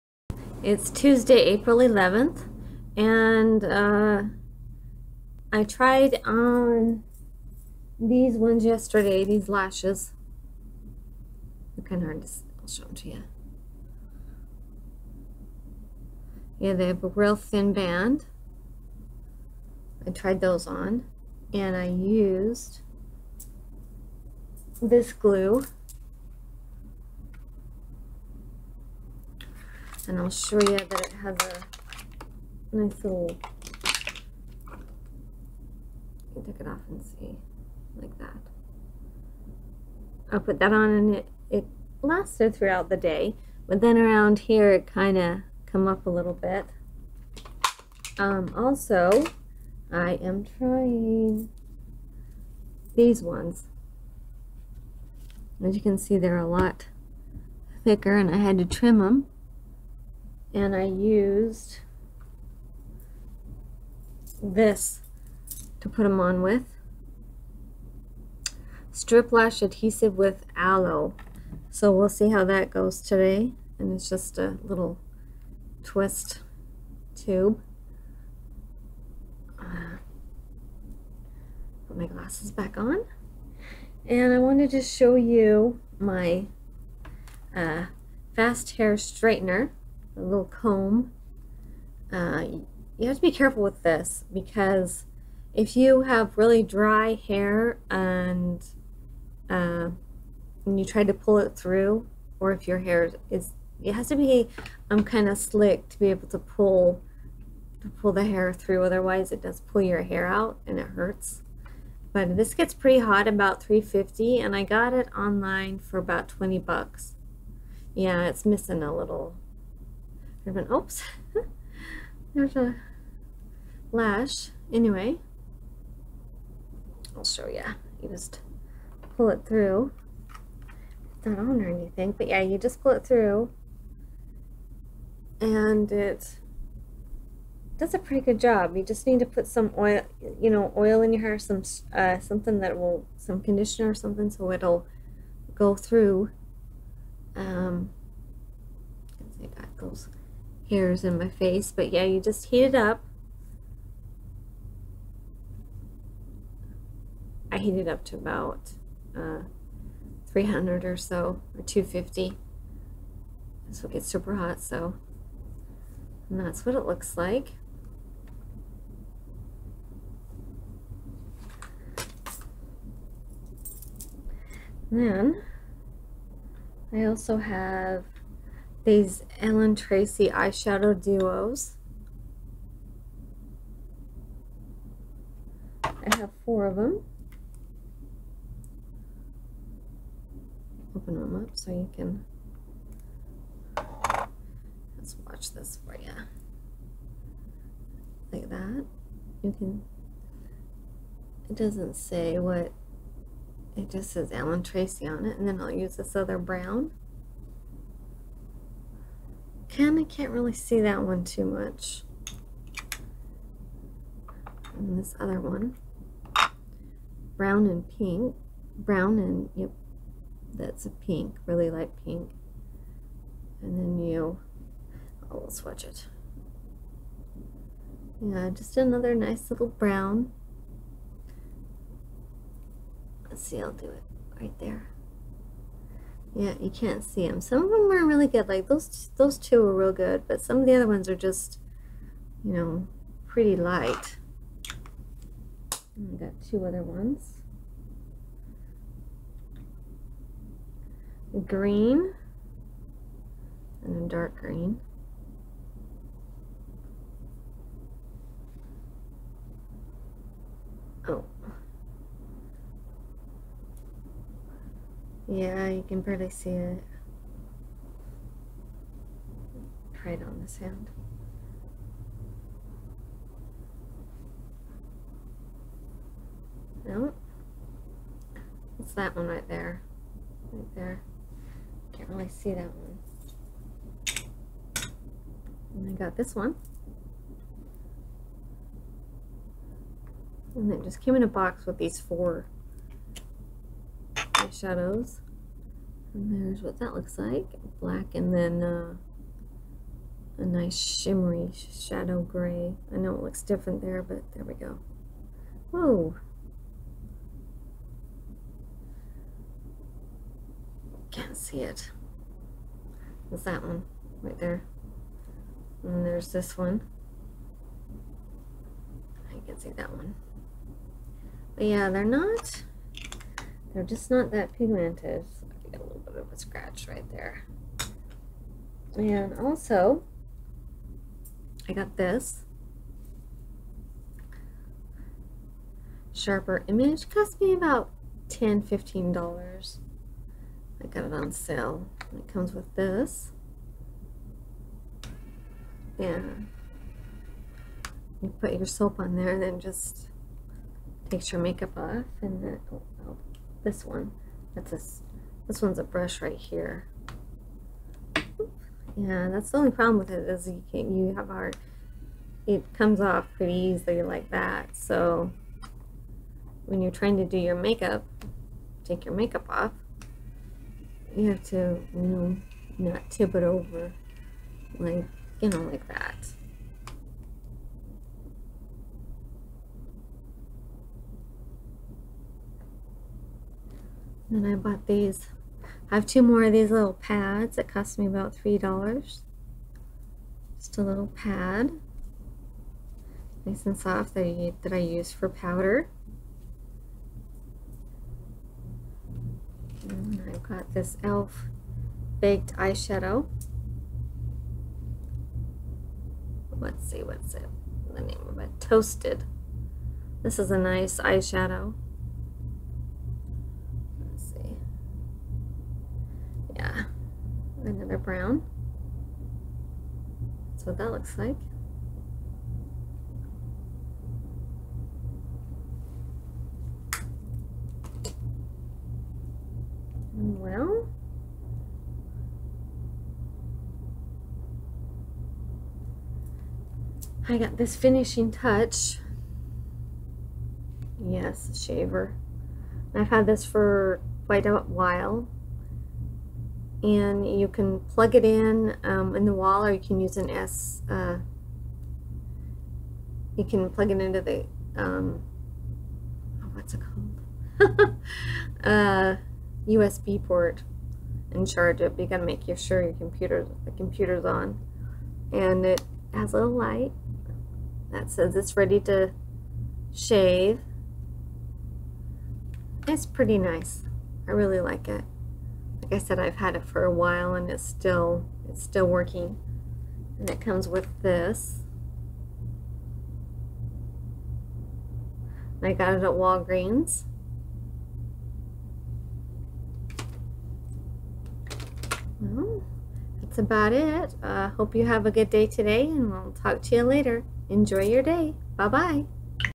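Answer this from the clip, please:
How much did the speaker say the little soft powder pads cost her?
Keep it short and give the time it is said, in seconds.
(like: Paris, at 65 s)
$3, at 388 s.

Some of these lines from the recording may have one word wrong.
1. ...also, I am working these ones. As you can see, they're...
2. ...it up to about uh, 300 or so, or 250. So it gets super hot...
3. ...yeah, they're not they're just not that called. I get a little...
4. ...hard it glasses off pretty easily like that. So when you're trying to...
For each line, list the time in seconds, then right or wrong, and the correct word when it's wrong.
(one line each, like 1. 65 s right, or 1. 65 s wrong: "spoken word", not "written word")
1. 48 s wrong: "trying", not "working"
2. 157 s right
3. 321 s wrong: "pigmented", not "called"
4. 361 s wrong: "comes", not "glasses".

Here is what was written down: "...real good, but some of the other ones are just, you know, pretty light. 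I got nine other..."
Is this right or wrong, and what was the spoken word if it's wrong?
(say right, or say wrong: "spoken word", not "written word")
wrong: "two", not "nine".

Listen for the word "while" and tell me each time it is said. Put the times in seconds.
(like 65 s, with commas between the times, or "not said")
444 s, 476 s.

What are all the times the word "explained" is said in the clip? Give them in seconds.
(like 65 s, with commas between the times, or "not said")
not said.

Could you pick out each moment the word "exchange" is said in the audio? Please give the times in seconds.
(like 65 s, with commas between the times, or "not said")
not said.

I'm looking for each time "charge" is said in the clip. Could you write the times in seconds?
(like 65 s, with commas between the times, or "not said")
461 s.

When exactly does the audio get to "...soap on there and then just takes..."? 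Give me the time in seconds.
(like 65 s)
348 s.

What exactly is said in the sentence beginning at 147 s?
Um, I can see that goes hairs in my face.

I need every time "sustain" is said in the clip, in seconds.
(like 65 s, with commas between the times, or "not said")
not said.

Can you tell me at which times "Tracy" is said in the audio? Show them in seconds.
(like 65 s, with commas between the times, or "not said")
179 s, 204 s.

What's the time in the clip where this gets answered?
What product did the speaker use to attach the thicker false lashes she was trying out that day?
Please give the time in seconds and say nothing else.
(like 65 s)
68 s.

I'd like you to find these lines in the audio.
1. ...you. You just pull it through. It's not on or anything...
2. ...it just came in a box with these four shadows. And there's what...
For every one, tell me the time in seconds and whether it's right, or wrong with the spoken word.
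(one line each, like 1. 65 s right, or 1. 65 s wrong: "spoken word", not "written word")
1. 127 s right
2. 290 s right.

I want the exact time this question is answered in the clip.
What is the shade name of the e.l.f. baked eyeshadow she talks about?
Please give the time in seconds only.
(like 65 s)
408 s.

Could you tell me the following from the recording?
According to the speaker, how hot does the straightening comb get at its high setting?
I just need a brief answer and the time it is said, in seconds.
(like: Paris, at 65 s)
350, at 113 s.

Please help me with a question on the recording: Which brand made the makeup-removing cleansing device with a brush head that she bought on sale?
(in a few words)
Sharper Image.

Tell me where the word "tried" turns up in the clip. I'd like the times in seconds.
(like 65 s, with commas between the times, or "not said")
5 s, 20 s.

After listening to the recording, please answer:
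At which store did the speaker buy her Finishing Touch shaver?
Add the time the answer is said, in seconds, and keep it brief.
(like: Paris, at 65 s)
Walgreens, at 486 s.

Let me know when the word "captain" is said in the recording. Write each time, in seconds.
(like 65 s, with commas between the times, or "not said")
not said.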